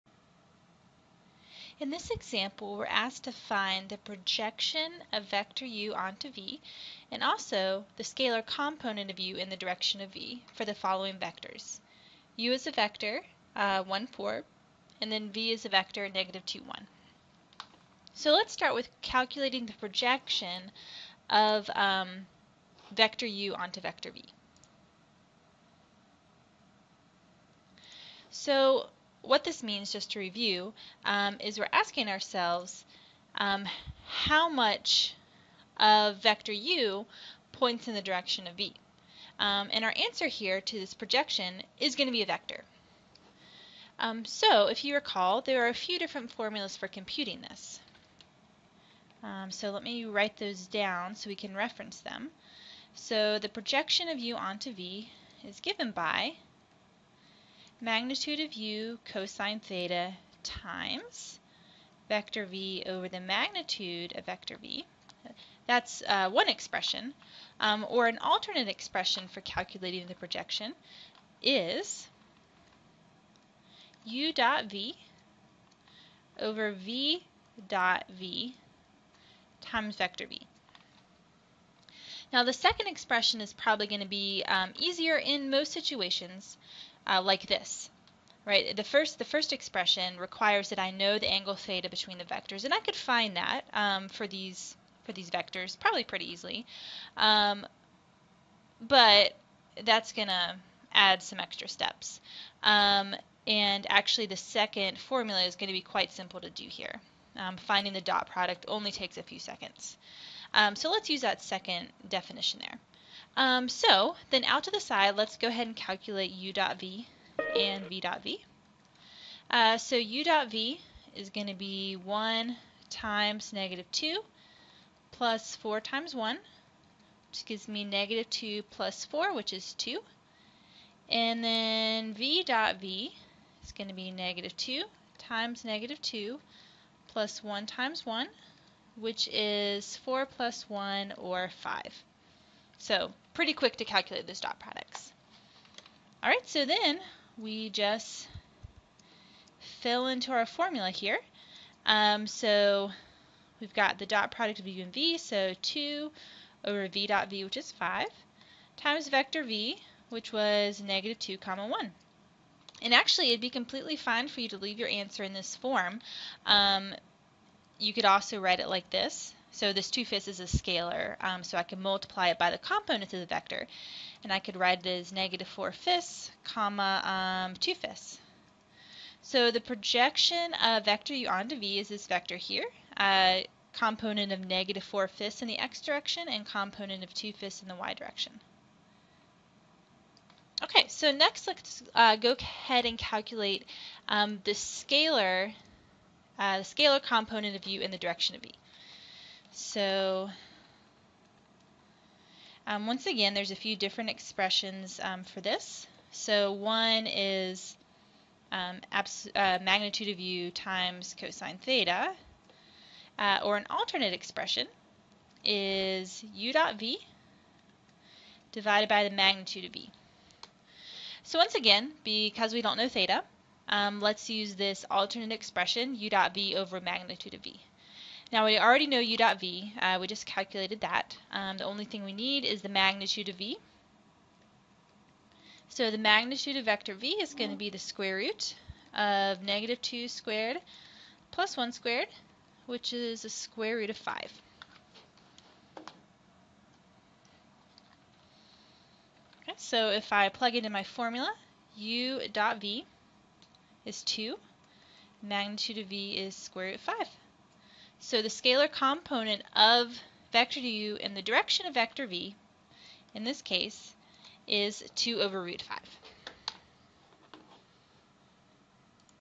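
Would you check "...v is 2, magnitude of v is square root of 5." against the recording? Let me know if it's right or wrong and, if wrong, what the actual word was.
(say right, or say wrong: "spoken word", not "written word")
right.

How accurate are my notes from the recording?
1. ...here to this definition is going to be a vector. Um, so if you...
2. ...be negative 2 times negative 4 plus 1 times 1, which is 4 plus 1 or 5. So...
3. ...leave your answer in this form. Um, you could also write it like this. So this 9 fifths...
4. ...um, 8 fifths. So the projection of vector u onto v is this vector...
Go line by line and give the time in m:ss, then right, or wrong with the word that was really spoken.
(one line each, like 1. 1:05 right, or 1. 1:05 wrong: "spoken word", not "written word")
1. 0:40 wrong: "projection", not "definition"
2. 2:13 wrong: "2", not "4"
3. 2:44 wrong: "2", not "9"
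4. 2:57 wrong: "2", not "8".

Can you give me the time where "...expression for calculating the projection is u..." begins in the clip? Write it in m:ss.
1:08.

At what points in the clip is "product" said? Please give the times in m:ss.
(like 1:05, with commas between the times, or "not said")
1:48, 2:24, 2:34.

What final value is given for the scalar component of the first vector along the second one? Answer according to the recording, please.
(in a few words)
2/√5.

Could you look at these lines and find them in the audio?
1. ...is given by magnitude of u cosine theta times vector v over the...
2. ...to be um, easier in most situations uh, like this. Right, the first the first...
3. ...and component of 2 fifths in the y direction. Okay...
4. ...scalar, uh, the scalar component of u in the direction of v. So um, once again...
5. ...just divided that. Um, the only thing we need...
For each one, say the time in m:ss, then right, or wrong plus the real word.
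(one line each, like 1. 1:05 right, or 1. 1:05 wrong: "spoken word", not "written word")
1. 0:55 right
2. 1:24 right
3. 3:06 right
4. 3:14 right
5. 3:50 wrong: "calculated", not "divided".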